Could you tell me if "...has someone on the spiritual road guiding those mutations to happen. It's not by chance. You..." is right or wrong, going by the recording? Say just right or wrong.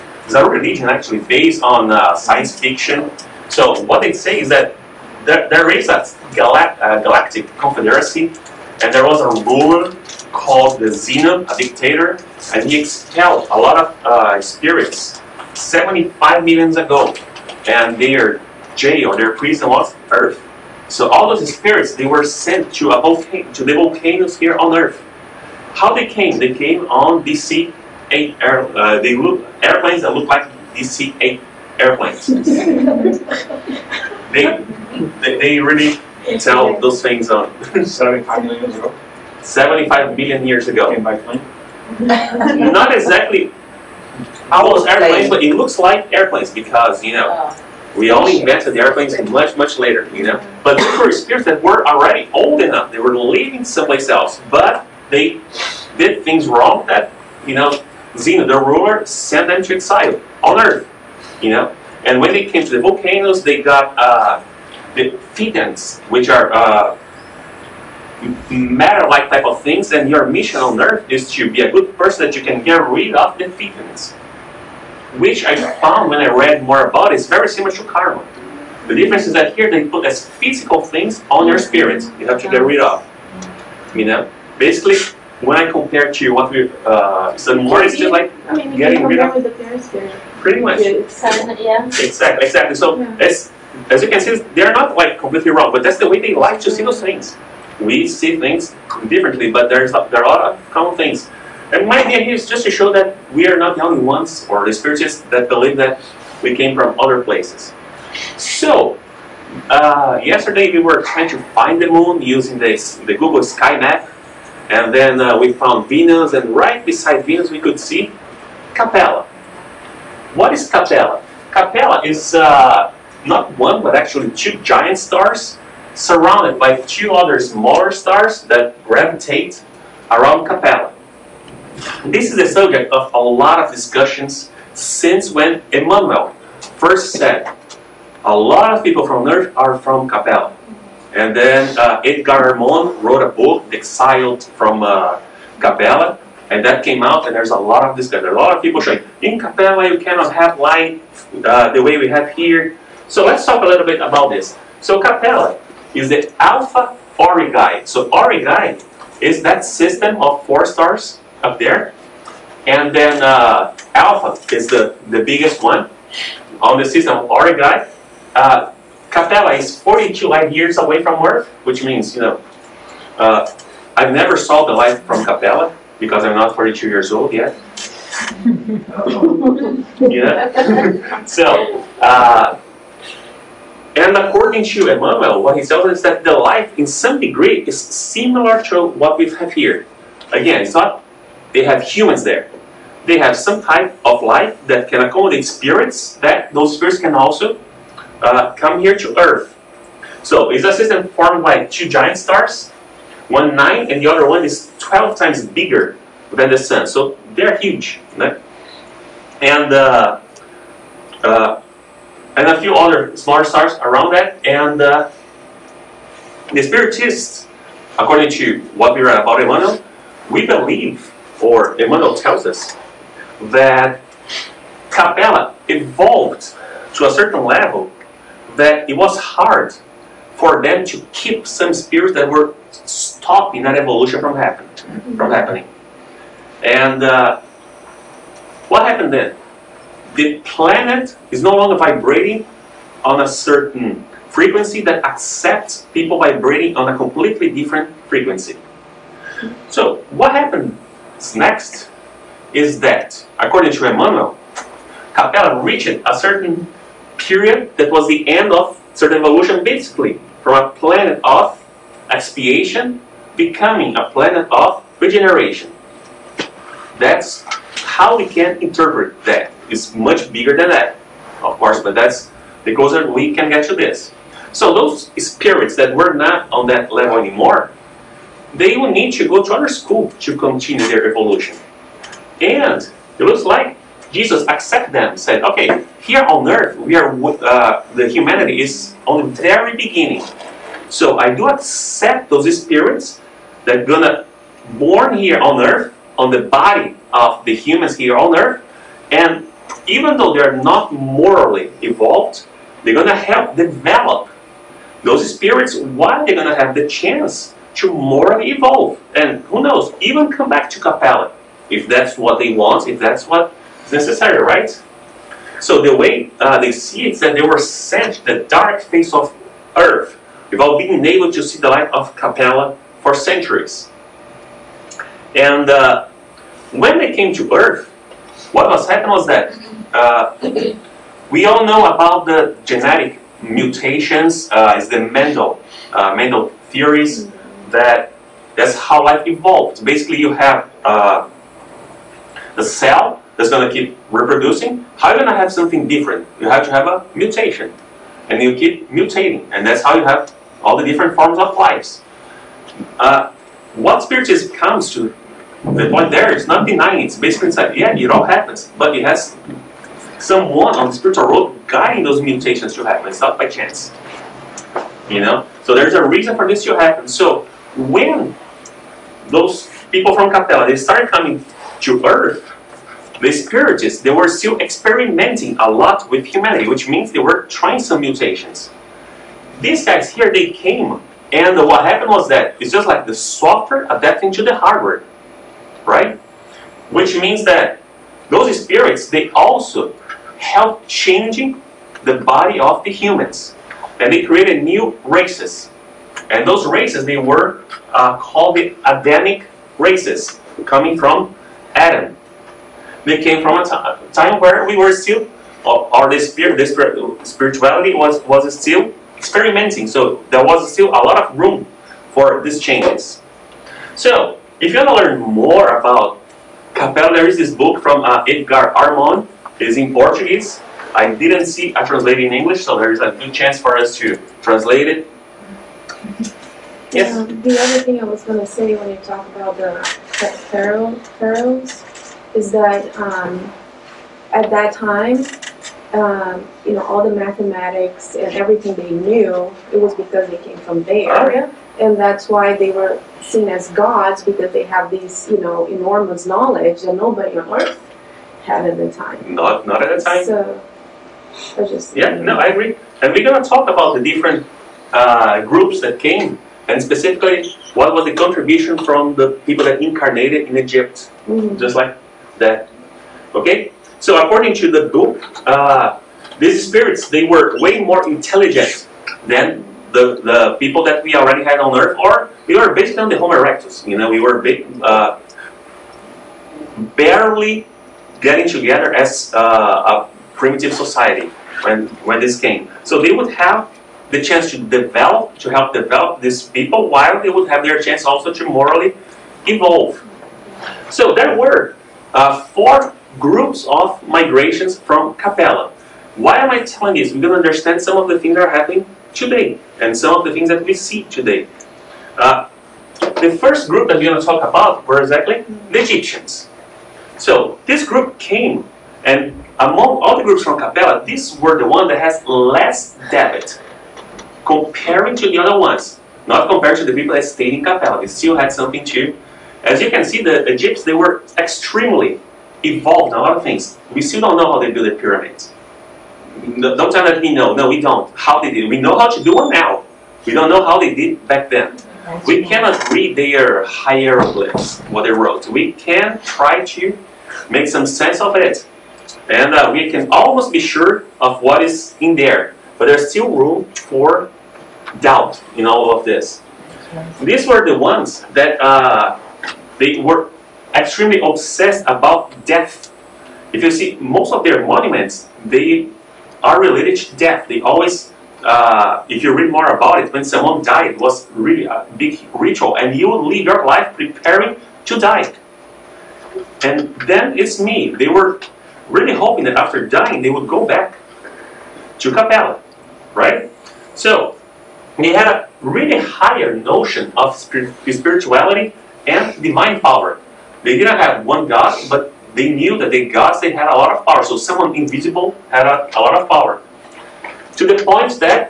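right.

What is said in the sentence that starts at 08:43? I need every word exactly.
We still don't know how they built the pyramids.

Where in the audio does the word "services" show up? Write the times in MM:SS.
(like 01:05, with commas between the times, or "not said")
not said.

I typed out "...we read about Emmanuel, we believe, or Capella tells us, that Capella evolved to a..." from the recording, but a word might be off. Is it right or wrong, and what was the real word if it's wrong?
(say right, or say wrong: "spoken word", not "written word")
wrong: "Emmanuel", not "Capella".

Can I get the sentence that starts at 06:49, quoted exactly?
So there was still a lot of room for these changes.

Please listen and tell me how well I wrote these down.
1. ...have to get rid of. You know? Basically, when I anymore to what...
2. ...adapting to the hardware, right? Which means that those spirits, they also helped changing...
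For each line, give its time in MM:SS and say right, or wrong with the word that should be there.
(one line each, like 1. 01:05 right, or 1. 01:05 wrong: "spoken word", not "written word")
1. 01:22 wrong: "compare", not "anymore"
2. 06:23 right.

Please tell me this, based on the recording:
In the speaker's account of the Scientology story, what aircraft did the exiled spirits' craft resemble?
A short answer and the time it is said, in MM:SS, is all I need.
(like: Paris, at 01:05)
DC-8 airplanes, at 00:27.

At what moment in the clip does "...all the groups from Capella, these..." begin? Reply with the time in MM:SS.
08:30.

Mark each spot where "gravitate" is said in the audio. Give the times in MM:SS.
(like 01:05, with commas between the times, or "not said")
02:08.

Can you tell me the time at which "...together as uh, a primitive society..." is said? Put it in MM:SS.
07:58.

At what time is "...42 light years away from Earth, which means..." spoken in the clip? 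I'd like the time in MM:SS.
02:49.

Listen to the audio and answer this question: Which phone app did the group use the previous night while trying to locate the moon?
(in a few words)
Google Sky Map.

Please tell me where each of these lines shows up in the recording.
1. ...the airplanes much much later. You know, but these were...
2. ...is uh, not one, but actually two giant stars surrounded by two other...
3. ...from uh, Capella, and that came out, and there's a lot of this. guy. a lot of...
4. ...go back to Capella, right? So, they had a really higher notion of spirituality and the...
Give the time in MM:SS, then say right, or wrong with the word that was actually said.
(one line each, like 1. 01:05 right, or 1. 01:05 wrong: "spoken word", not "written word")
1. 00:48 right
2. 02:02 right
3. 02:24 right
4. 09:30 right.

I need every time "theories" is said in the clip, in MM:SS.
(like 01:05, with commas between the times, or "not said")
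05:36.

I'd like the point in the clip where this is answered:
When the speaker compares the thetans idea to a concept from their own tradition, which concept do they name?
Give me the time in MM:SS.
01:17.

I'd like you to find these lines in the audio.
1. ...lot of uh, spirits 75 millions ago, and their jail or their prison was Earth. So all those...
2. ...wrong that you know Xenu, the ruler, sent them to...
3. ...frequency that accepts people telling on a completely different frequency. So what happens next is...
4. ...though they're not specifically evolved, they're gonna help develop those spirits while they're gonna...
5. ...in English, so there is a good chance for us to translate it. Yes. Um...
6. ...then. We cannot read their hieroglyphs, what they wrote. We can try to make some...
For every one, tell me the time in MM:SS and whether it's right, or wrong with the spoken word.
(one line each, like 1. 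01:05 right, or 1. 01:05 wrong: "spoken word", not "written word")
1. 00:13 right
2. 00:56 right
3. 04:04 wrong: "vibrating", not "telling"
4. 05:00 wrong: "morally", not "specifically"
5. 07:02 right
6. 08:51 right.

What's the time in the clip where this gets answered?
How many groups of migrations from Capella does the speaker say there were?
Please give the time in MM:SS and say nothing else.
08:12.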